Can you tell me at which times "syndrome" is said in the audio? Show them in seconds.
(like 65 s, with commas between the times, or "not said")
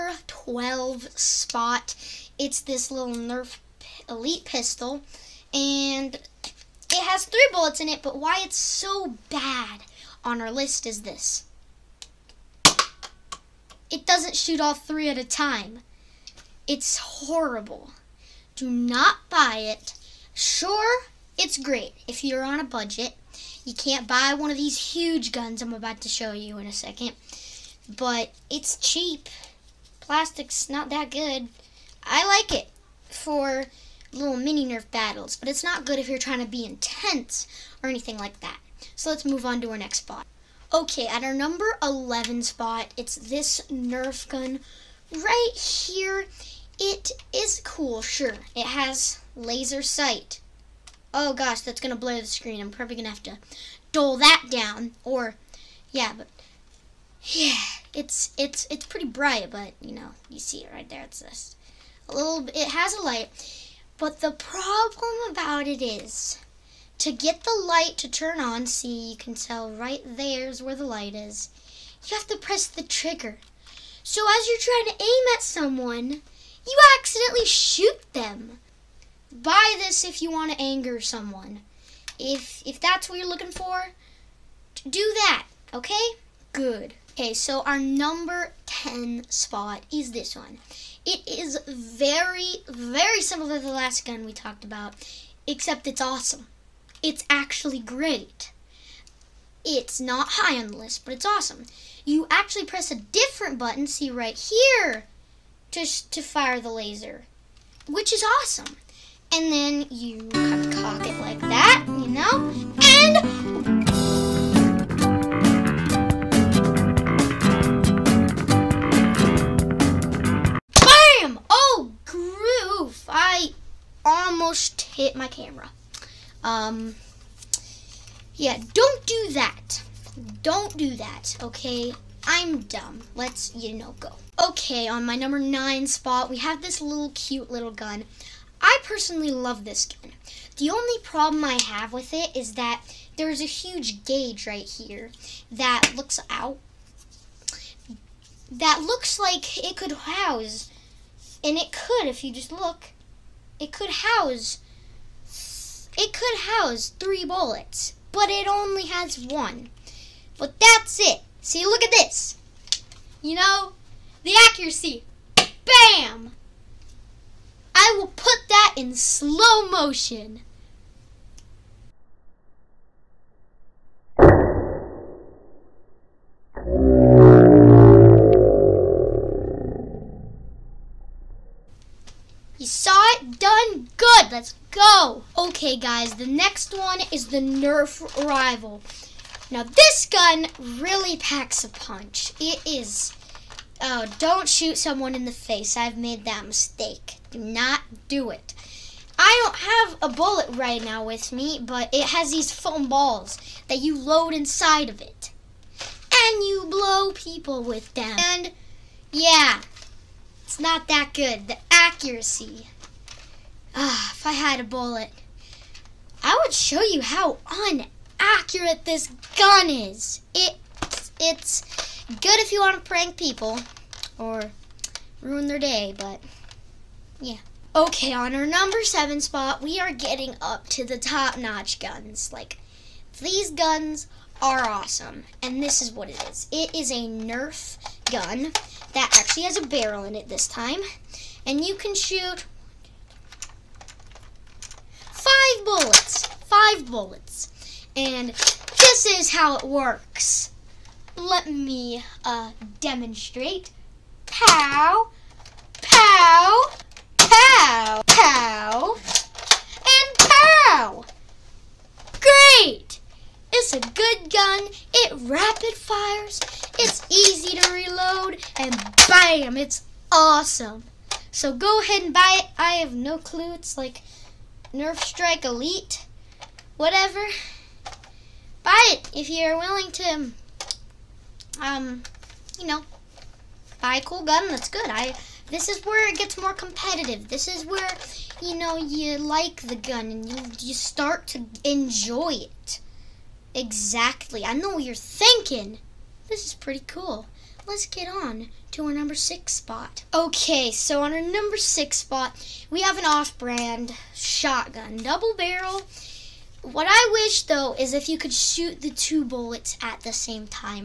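not said.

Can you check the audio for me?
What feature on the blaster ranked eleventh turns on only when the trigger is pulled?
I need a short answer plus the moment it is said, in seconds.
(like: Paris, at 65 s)
laser sight, at 49 s.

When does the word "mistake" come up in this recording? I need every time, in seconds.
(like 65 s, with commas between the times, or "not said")
196 s.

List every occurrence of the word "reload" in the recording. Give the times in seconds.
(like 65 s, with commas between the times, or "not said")
267 s.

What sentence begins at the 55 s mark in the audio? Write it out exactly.
Or, yeah, but, yeah, it's, it's, it's pretty bright, but, you know, you see it right there.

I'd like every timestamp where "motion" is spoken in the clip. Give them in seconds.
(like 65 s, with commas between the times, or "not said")
169 s.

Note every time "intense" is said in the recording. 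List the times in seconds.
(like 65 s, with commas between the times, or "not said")
36 s.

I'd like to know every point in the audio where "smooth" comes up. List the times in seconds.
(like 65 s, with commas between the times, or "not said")
not said.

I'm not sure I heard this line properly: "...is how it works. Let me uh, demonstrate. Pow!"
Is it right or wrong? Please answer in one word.
right.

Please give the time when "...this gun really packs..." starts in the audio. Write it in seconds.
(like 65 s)
189 s.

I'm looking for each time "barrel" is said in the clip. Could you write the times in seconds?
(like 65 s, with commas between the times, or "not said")
239 s, 305 s.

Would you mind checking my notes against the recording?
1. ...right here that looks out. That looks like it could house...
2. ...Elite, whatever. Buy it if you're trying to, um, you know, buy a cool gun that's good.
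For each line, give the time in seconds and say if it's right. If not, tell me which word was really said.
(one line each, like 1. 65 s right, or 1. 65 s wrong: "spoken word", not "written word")
1. 144 s right
2. 275 s wrong: "willing", not "trying".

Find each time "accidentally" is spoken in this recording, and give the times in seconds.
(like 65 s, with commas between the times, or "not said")
76 s.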